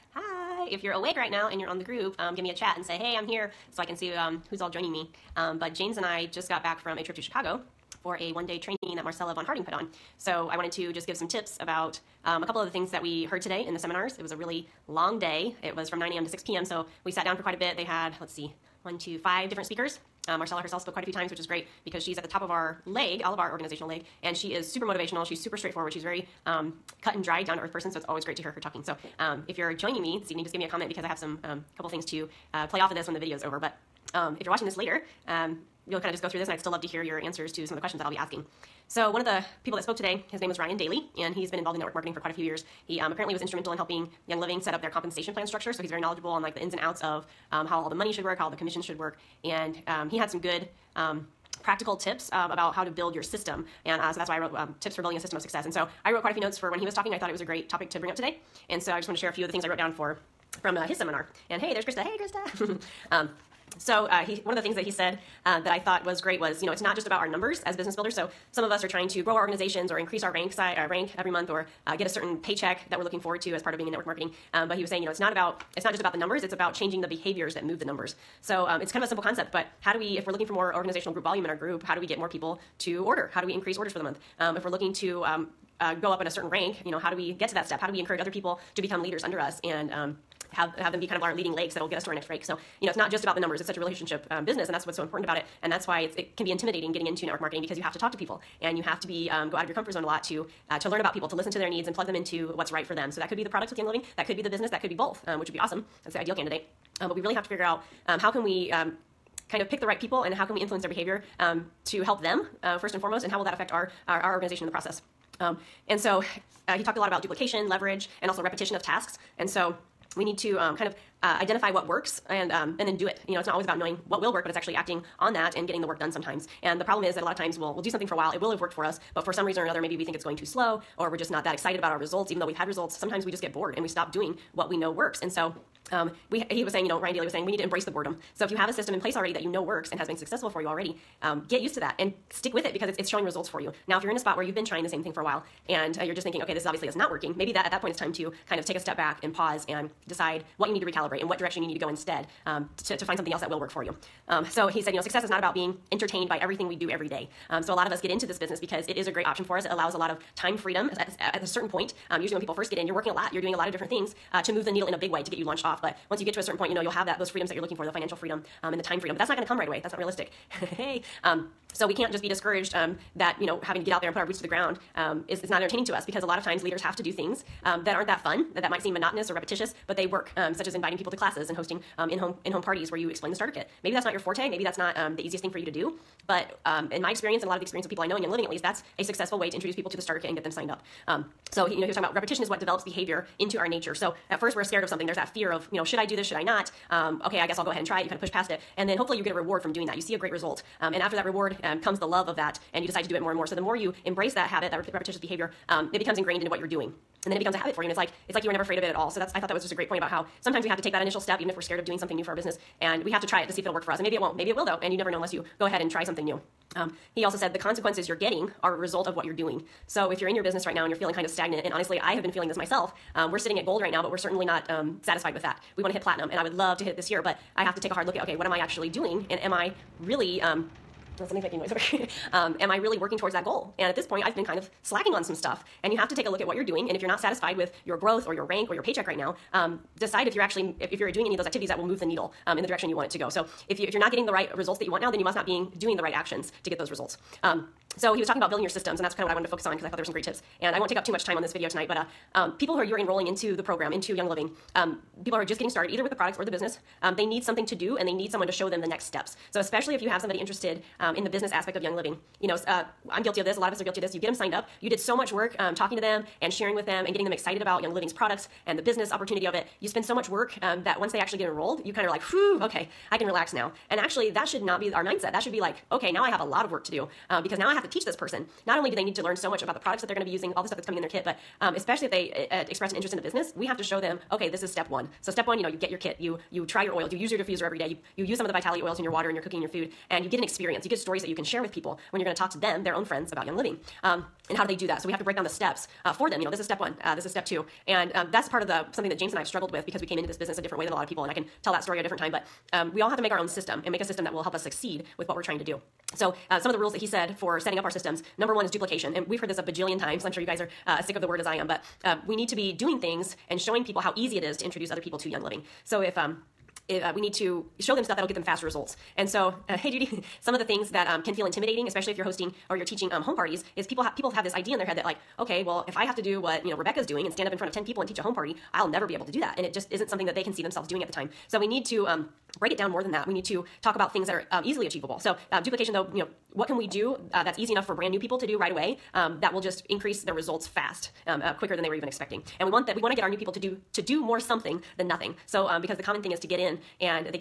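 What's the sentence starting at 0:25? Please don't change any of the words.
She's very um, cut and dry, down to earth person.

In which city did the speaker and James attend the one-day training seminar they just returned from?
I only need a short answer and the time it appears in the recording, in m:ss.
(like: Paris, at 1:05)
Chicago, at 0:07.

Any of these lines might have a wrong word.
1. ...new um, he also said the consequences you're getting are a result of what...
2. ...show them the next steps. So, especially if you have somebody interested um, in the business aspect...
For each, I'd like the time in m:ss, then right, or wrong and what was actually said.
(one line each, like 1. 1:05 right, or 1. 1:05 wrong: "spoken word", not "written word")
1. 3:36 right
2. 4:18 right.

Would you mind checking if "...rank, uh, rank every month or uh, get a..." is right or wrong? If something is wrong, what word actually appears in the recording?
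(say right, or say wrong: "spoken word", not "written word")
right.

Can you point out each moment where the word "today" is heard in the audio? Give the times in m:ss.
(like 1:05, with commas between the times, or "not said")
0:13, 0:39, 0:58.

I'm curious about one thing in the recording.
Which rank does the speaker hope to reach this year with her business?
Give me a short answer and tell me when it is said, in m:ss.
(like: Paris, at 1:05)
Platinum, at 3:46.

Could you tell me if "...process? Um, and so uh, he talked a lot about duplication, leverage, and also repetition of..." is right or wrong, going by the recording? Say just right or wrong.
right.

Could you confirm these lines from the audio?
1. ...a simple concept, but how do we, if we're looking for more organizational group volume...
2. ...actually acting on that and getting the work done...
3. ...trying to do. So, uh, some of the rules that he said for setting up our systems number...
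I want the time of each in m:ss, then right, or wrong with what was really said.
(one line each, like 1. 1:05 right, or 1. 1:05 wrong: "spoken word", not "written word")
1. 1:19 right
2. 2:04 right
3. 5:05 right.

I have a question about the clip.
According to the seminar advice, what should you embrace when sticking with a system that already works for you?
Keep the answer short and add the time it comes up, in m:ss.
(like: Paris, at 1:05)
Boredom, at 2:17.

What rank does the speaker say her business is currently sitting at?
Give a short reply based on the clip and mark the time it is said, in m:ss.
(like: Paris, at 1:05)
Gold, at 3:43.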